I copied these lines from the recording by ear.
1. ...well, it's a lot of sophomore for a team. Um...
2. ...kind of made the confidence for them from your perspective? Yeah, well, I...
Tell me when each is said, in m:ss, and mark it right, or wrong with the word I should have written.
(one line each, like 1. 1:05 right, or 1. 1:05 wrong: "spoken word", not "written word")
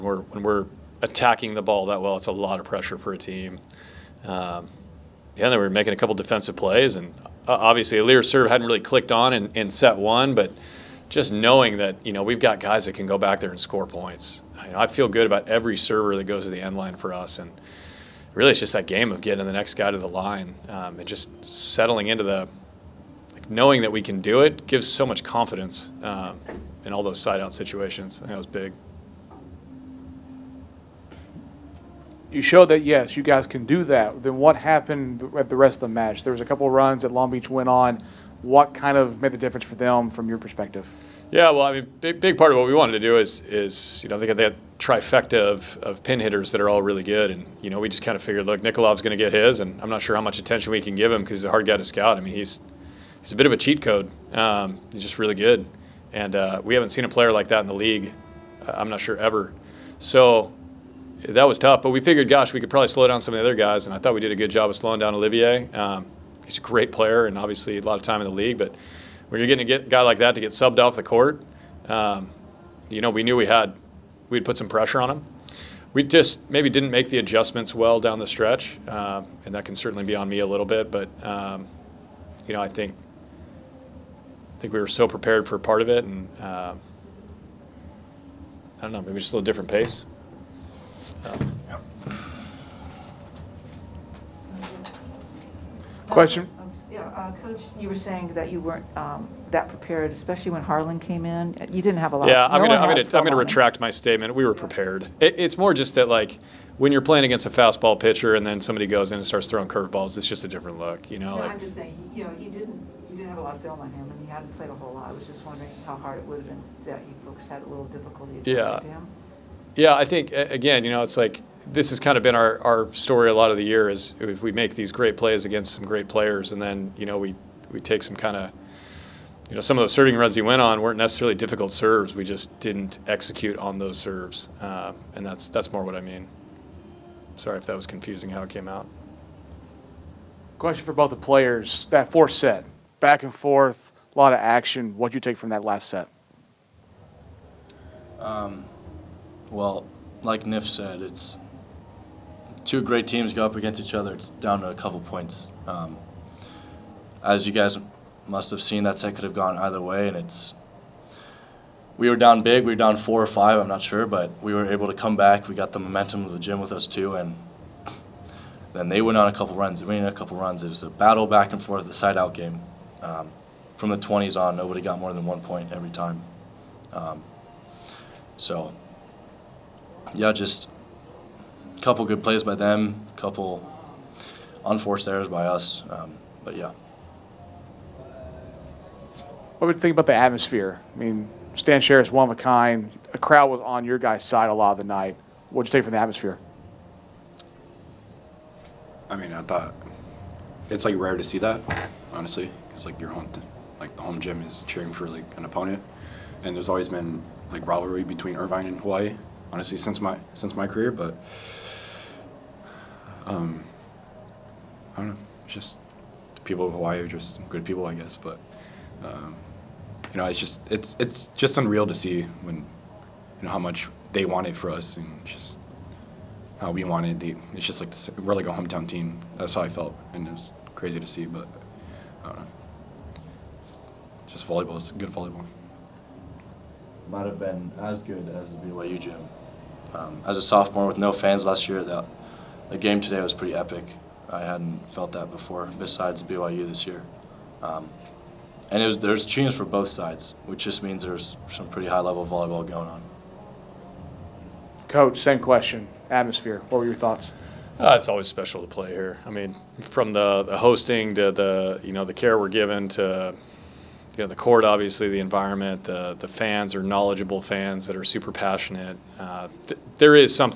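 1. 0:02 wrong: "pressure", not "sophomore"
2. 0:38 wrong: "difference", not "confidence".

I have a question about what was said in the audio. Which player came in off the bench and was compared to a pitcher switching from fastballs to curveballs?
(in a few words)
Harlan.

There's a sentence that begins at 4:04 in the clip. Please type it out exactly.
I hadn't felt that before, besides BYU this year.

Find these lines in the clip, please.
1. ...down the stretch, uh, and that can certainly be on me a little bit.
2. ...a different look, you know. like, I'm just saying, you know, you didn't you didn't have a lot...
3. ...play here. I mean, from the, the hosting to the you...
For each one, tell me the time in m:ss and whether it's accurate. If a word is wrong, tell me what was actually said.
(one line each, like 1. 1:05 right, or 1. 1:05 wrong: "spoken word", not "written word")
1. 1:17 right
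2. 1:50 right
3. 4:18 right.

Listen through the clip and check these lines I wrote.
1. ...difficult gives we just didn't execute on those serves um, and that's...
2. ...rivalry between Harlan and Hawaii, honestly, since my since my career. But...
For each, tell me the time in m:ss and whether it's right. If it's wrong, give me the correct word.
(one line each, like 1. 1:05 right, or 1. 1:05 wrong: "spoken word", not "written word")
1. 2:11 wrong: "serves", not "gives"
2. 3:27 wrong: "Irvine", not "Harlan".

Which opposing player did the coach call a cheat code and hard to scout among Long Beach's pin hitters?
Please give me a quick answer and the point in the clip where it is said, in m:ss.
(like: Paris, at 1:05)
Nikolov, at 0:48.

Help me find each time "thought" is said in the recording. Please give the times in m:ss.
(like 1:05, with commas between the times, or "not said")
1:03, 3:19, 4:16.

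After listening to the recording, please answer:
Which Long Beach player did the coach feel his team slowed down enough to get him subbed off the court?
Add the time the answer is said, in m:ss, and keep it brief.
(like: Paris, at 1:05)
Olivier, at 1:05.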